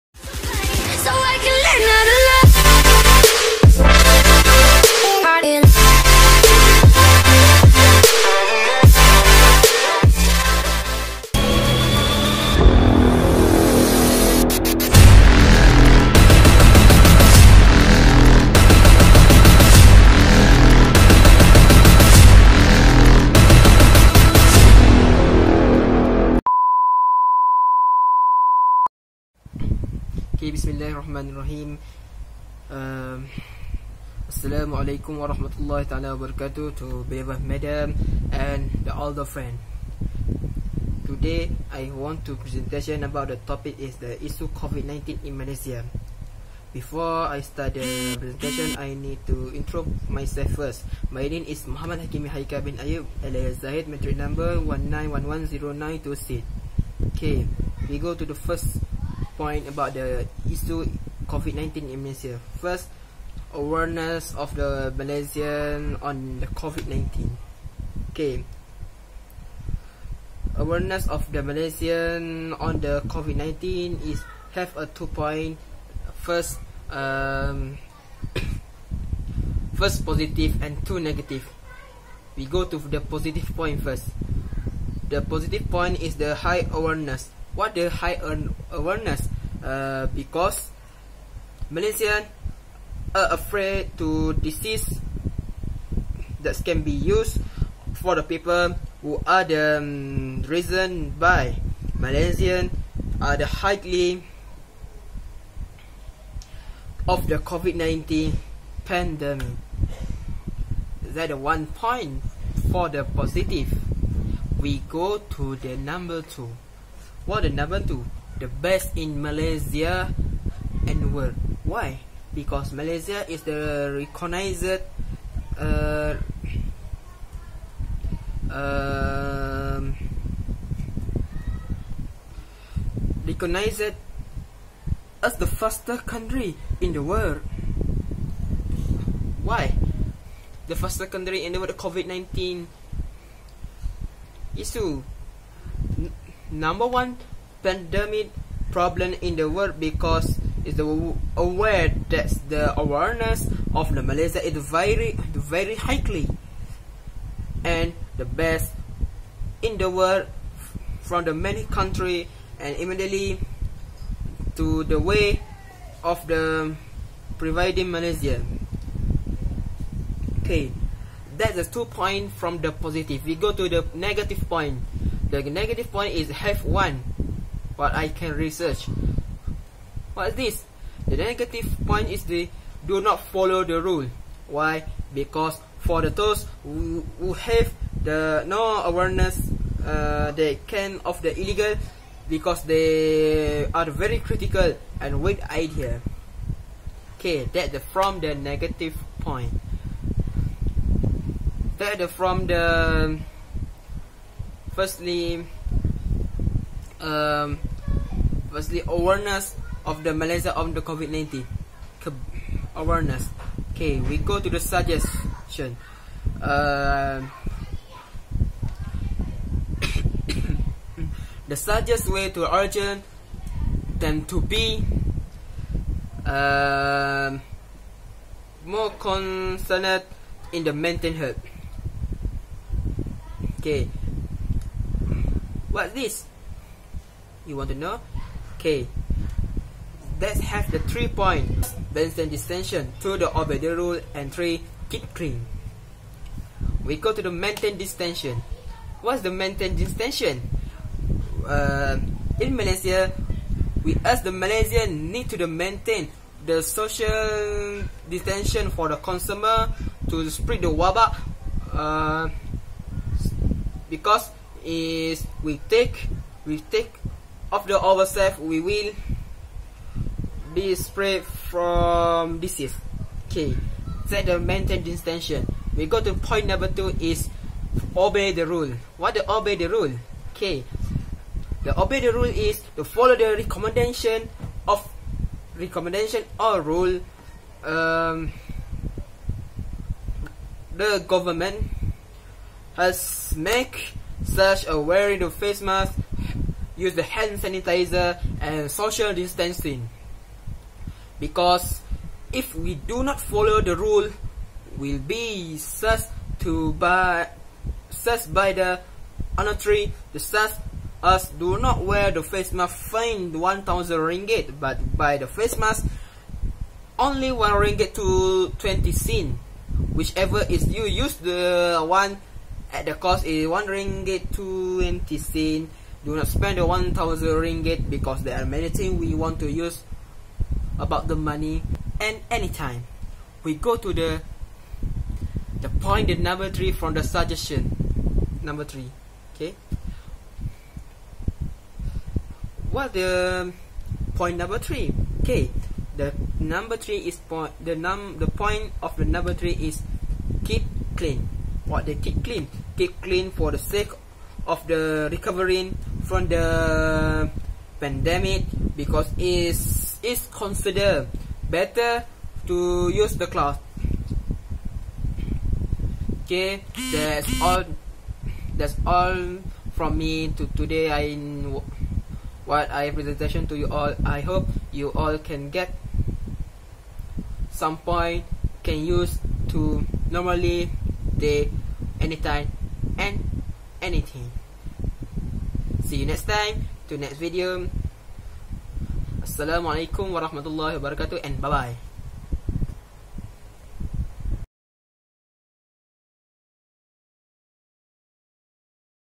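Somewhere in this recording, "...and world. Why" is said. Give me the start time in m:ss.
2:00.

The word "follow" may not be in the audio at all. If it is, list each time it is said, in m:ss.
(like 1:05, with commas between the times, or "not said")
3:03, 4:42, 5:03.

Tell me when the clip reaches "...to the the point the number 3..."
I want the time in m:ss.
5:33.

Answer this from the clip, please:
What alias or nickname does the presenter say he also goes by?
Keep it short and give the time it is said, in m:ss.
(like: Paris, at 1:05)
Zahid, at 0:53.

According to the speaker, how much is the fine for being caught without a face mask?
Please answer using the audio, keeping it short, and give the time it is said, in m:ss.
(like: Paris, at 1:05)
1000 ringgit, at 5:12.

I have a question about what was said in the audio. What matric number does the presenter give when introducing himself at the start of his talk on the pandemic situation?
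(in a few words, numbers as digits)
19110926.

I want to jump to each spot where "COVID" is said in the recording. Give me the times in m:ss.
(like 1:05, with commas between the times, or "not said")
0:44, 1:01, 1:06, 1:13, 1:47, 2:21, 3:30.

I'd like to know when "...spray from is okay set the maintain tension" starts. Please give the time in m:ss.
4:30.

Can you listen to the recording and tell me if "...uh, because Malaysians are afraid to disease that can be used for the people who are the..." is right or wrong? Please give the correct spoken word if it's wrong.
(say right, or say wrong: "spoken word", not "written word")
right.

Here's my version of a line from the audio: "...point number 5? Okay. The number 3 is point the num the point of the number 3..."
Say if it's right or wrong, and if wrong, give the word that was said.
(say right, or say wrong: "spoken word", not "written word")
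wrong: "3", not "5".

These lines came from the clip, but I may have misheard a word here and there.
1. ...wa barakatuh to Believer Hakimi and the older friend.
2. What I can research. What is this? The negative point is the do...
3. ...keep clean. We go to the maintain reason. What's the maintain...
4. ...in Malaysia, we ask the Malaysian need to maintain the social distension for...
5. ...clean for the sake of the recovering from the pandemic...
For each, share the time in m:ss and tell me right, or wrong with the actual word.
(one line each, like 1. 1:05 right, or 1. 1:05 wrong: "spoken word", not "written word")
1. 0:36 wrong: "Madam", not "Hakimi"
2. 2:57 right
3. 4:04 wrong: "distension", not "reason"
4. 4:12 right
5. 5:53 right.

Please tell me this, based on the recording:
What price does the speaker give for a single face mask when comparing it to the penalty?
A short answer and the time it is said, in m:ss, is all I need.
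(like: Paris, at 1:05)
1 ringgit 20 cent, at 5:23.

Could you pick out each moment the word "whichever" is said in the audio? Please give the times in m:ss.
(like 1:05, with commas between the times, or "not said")
5:19.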